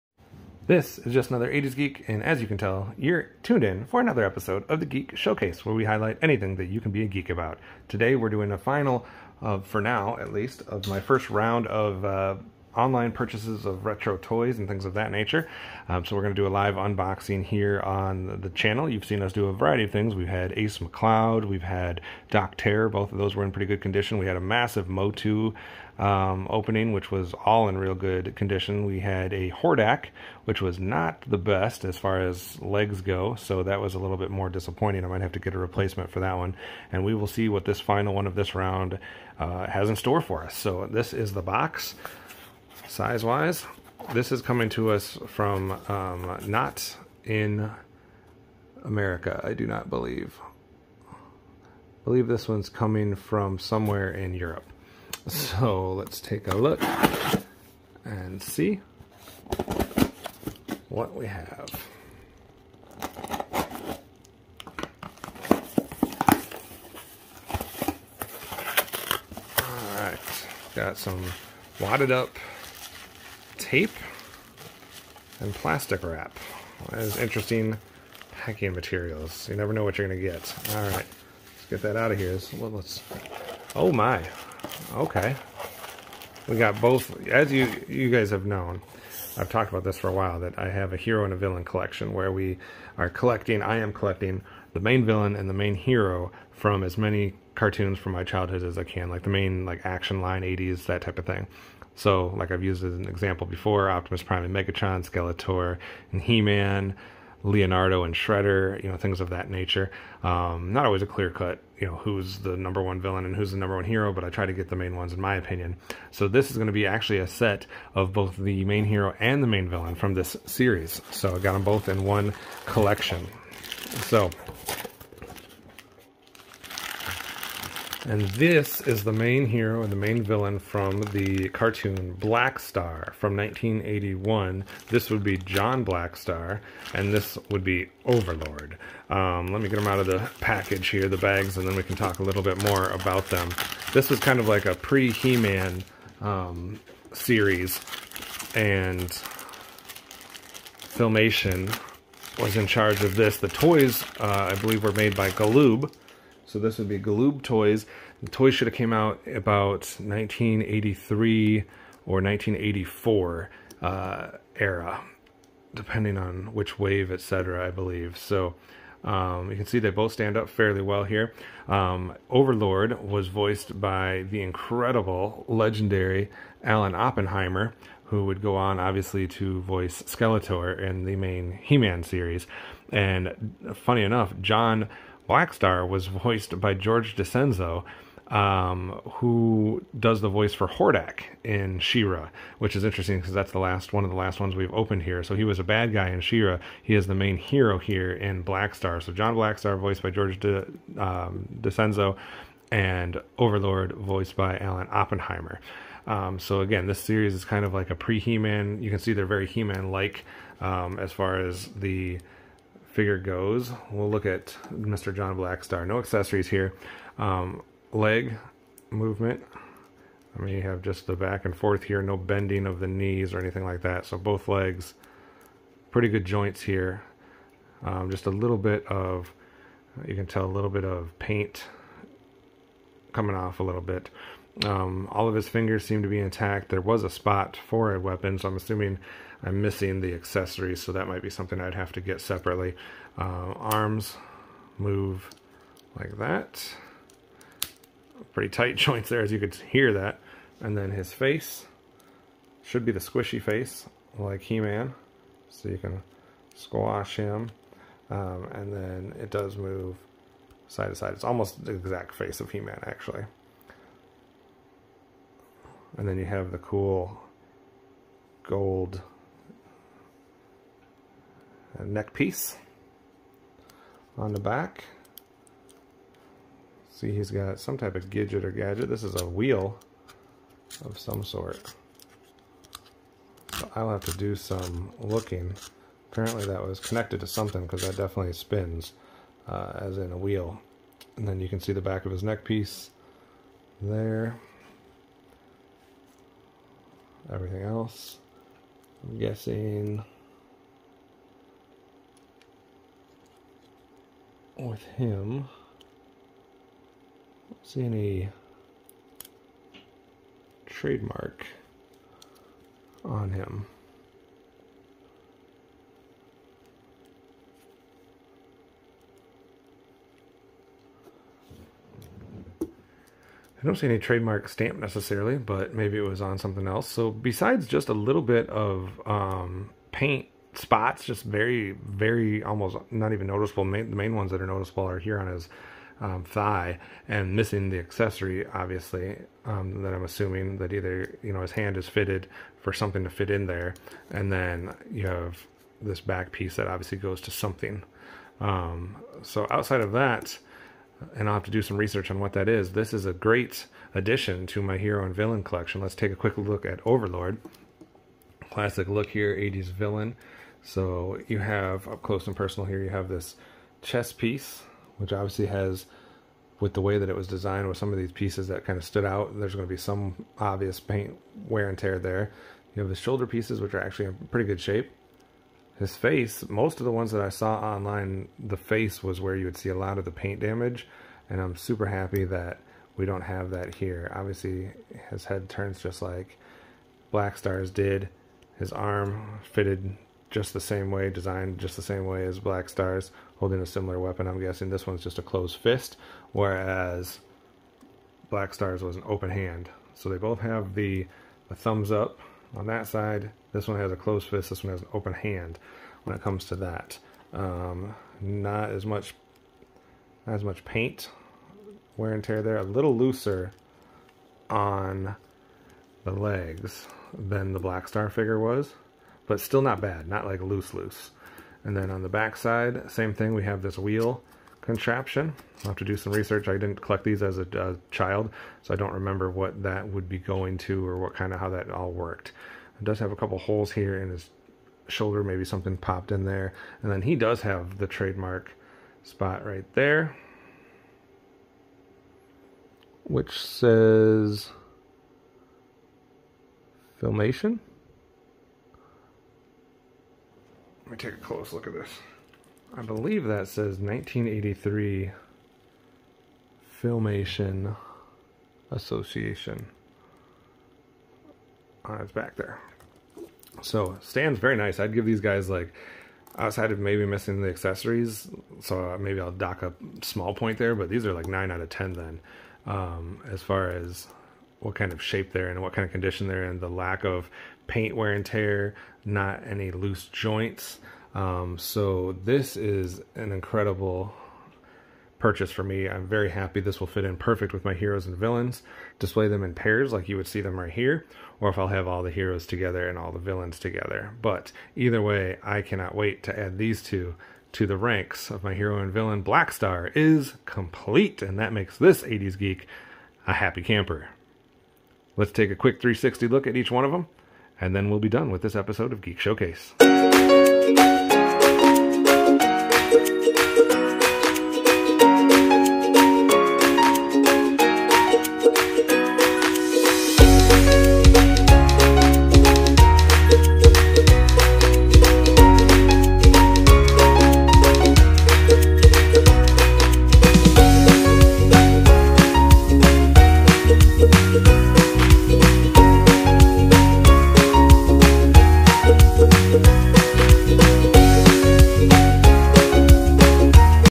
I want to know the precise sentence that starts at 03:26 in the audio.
Um, so again, this series is kind of like a pre-He-Man.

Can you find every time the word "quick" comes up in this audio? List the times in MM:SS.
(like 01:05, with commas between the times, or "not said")
05:56, 08:25.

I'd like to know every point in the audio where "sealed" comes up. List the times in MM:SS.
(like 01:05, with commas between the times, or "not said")
not said.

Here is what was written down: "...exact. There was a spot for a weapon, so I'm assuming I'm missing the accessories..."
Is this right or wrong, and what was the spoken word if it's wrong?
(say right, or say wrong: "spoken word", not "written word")
wrong: "intact", not "exact".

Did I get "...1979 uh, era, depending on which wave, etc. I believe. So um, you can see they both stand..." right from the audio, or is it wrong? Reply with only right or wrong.
wrong.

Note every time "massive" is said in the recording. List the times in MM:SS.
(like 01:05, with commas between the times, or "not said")
00:24.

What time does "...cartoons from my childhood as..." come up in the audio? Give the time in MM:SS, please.
01:37.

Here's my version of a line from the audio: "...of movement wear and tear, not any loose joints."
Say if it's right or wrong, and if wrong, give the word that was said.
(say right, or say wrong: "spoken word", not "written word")
wrong: "paint", not "movement".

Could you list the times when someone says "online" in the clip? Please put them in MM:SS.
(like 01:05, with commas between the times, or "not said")
00:12, 06:17.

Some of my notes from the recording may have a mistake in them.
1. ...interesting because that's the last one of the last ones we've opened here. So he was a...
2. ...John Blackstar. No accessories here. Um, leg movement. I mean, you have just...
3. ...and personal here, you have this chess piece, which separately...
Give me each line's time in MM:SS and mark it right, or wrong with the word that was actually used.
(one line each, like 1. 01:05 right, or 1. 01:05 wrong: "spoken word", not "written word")
1. 03:12 right
2. 03:35 right
3. 06:02 wrong: "obviously", not "separately".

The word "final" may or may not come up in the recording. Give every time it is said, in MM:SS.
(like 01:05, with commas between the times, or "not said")
00:08, 00:37.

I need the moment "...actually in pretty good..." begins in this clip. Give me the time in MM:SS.
06:13.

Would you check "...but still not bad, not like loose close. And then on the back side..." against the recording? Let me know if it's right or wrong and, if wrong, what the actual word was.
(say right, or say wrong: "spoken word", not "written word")
wrong: "loose", not "close".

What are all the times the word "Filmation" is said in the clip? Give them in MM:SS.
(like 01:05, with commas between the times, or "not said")
02:30, 07:27, 07:36.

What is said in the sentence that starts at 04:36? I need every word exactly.
See, he's got some type of gadget or gadget.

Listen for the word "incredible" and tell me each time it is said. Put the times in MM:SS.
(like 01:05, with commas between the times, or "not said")
02:54, 08:03.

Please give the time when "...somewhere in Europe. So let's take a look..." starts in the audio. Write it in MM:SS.
00:53.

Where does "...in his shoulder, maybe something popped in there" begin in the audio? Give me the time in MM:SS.
07:14.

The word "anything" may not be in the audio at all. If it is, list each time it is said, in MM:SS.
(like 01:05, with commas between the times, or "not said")
00:06, 03:43.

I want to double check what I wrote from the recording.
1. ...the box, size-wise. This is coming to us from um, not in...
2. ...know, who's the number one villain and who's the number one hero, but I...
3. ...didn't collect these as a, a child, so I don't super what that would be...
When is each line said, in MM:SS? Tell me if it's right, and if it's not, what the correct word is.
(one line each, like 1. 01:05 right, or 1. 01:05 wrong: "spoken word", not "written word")
1. 00:41 right
2. 01:51 right
3. 07:06 wrong: "remember", not "super".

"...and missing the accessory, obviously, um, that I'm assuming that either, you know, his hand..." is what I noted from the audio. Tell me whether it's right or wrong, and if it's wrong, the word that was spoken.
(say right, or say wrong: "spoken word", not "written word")
right.